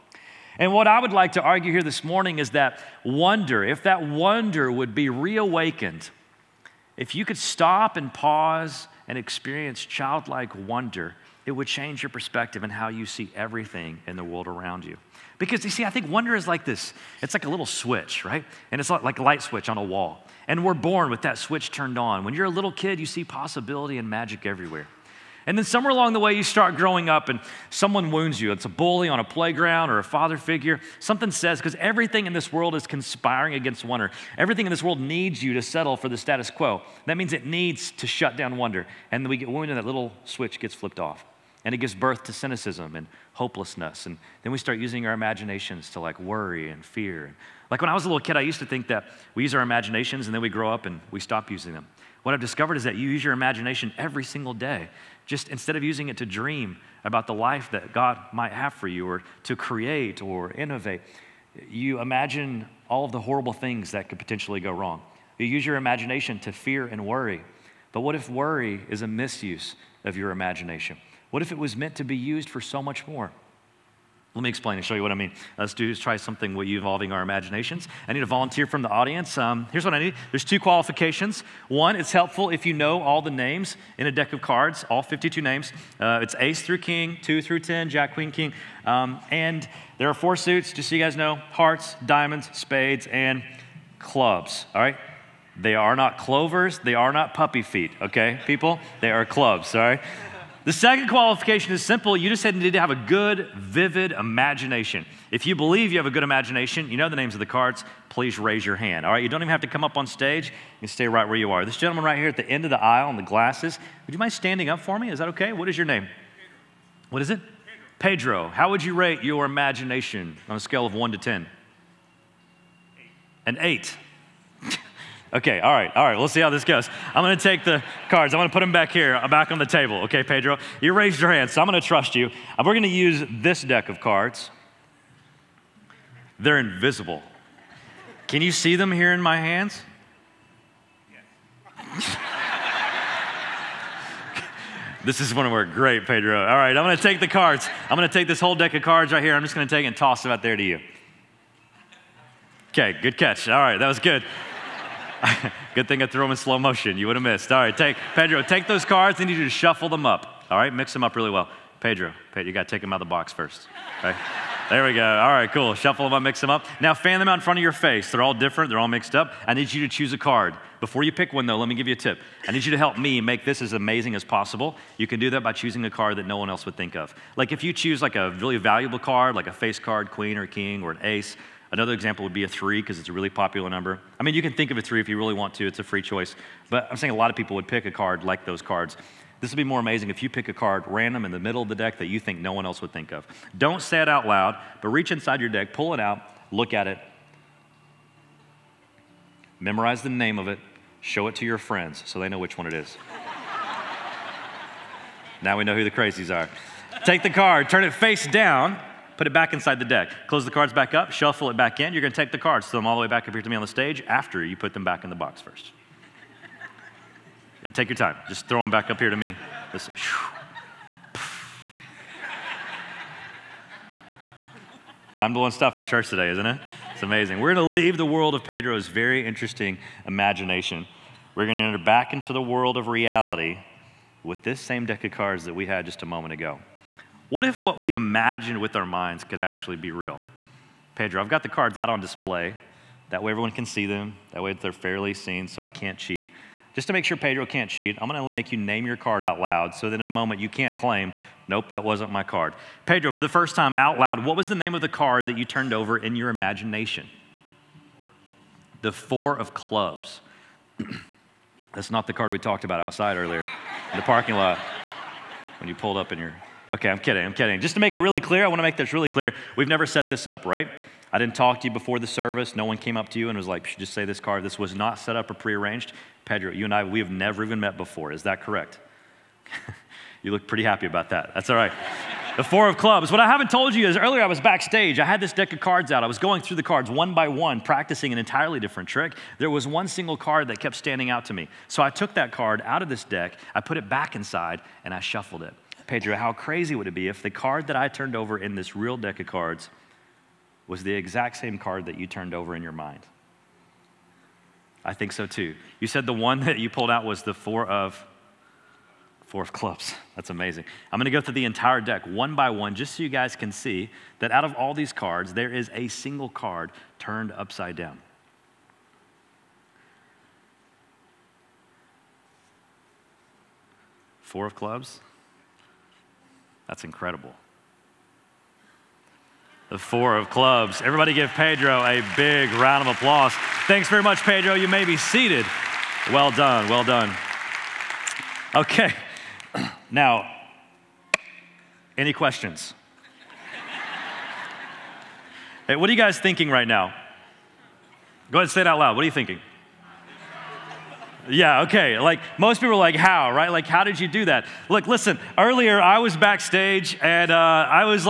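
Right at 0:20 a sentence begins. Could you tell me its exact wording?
And we're born with that switch turned on.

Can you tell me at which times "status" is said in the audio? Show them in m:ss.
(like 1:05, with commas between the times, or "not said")
0:36.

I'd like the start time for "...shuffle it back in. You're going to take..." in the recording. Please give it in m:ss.
3:31.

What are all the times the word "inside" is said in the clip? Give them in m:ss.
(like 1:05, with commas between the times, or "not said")
3:15, 3:29, 4:54.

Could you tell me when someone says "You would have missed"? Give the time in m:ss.
2:36.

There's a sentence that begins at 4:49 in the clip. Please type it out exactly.
There was one single card that kept standing out to me.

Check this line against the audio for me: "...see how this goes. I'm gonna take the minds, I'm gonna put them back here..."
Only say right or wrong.
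wrong.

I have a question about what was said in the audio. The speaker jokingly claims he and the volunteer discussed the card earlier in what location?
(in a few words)
parking lot.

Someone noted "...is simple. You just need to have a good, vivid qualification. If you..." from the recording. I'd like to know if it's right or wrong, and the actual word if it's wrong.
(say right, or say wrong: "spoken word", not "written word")
wrong: "imagination", not "qualification".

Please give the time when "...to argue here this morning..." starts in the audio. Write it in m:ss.
0:01.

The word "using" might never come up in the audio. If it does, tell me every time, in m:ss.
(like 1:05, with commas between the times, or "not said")
0:44, 0:51, 0:55.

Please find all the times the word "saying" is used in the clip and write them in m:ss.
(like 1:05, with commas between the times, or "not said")
3:06.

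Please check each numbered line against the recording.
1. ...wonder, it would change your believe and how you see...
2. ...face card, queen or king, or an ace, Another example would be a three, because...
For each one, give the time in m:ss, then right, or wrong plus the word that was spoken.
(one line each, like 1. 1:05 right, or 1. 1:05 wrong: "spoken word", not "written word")
1. 0:10 wrong: "perspective", not "believe"
2. 2:59 right.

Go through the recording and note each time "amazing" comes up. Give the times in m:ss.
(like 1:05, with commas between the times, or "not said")
2:53, 3:09, 3:47, 5:10.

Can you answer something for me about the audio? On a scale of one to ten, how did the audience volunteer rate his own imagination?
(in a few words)
8.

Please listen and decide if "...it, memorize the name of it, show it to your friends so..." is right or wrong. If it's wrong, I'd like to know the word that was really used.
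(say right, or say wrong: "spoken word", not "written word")
right.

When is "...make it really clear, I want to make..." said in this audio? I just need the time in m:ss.
4:27.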